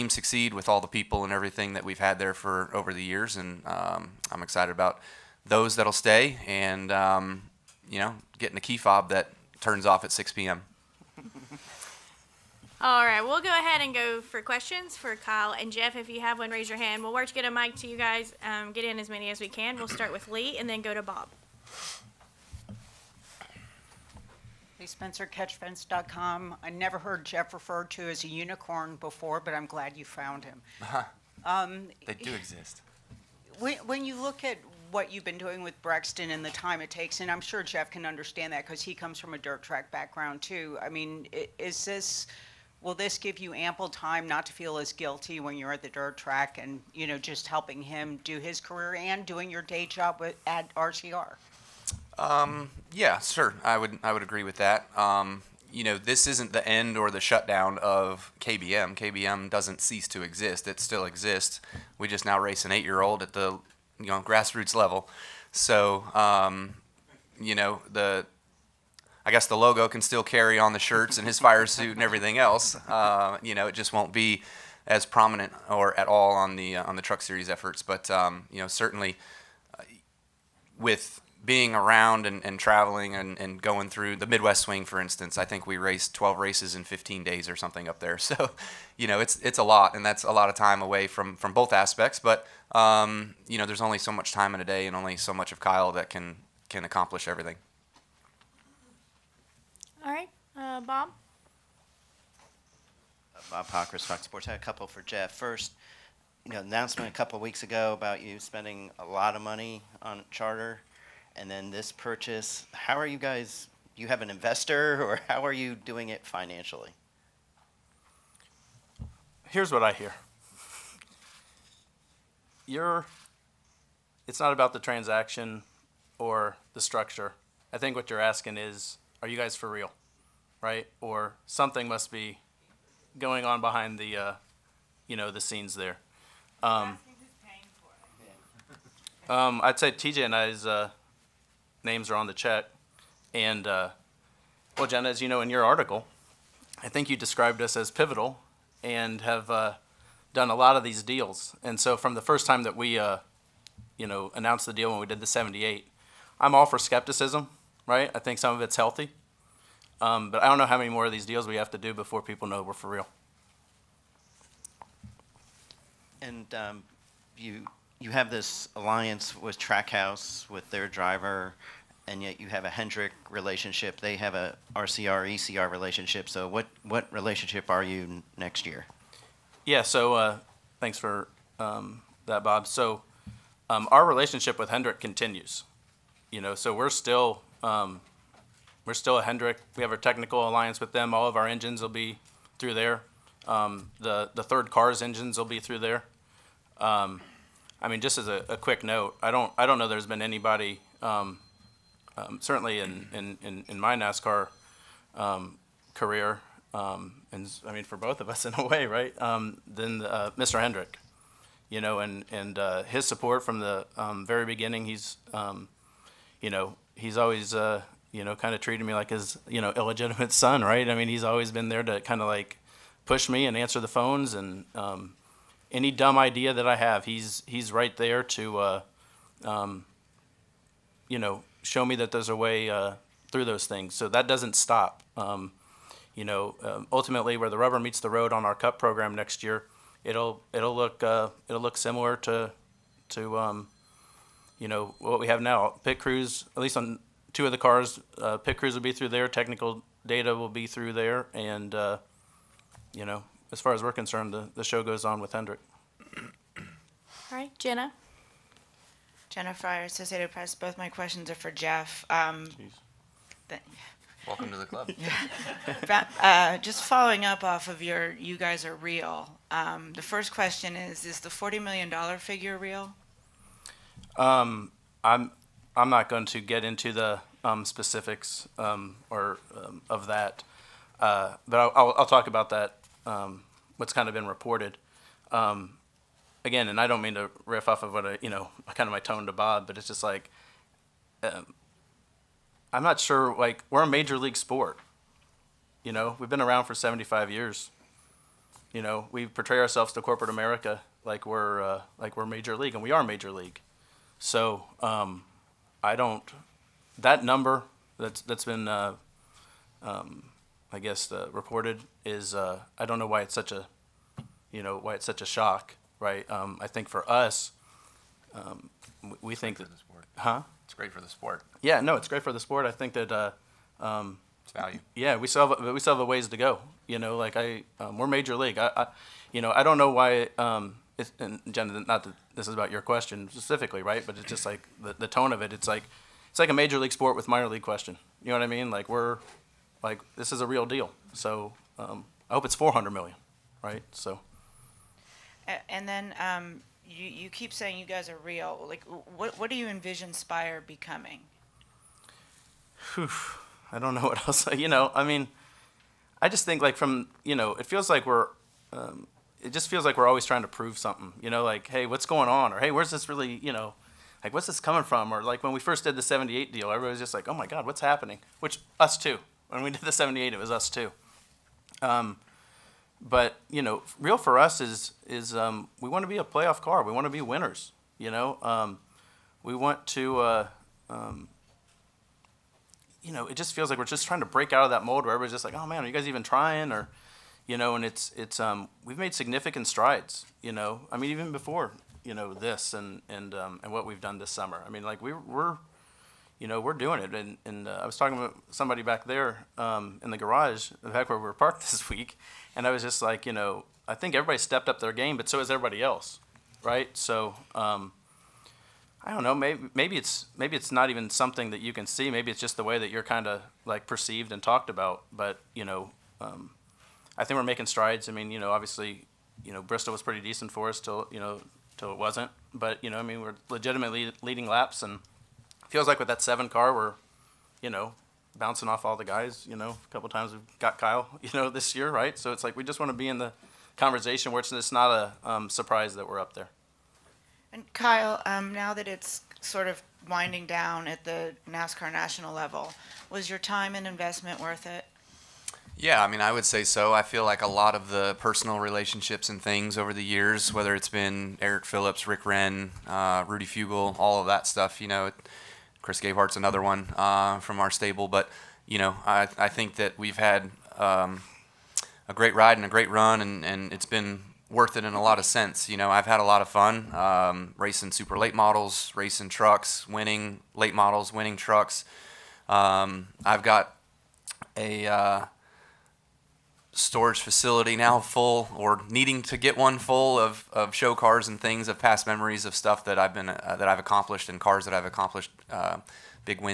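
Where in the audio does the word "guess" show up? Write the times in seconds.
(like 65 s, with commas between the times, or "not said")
69 s, 310 s.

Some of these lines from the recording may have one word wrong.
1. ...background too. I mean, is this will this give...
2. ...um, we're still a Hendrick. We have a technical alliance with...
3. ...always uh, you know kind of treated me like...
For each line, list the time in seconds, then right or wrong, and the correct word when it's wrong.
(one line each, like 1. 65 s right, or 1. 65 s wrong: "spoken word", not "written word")
1. 39 s right
2. 187 s right
3. 217 s right.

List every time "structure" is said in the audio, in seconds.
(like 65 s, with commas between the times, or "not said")
126 s.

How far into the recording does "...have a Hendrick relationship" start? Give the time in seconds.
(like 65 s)
172 s.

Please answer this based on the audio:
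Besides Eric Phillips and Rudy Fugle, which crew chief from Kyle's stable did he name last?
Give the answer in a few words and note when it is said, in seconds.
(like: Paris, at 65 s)
Chris Gabehart, at 455 s.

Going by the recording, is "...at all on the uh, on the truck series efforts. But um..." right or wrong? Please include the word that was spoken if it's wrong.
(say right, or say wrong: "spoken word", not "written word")
right.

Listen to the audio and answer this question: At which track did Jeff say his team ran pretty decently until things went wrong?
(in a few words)
Bristol.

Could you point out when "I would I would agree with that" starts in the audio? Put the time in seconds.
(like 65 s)
53 s.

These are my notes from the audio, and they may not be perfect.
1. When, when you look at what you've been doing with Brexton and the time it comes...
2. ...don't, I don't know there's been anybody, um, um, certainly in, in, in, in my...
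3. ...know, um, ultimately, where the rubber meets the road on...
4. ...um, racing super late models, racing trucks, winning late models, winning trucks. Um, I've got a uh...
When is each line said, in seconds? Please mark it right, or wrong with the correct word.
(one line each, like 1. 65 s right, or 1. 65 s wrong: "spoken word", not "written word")
1. 33 s wrong: "takes", not "comes"
2. 199 s right
3. 236 s right
4. 466 s right.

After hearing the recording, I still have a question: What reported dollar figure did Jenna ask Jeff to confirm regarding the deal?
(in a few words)
$40 million.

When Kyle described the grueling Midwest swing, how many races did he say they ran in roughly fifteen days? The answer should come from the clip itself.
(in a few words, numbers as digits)
12.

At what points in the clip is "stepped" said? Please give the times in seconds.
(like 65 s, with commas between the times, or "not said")
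404 s.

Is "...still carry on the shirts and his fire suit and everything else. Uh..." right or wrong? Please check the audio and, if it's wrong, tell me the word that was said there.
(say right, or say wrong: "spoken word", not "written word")
right.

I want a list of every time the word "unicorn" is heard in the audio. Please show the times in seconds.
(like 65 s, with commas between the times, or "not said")
28 s.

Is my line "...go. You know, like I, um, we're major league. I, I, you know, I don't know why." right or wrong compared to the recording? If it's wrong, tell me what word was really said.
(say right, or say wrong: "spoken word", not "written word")
right.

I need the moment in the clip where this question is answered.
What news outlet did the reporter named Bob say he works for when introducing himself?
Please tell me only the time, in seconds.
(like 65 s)
104 s.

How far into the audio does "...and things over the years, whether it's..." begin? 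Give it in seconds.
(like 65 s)
449 s.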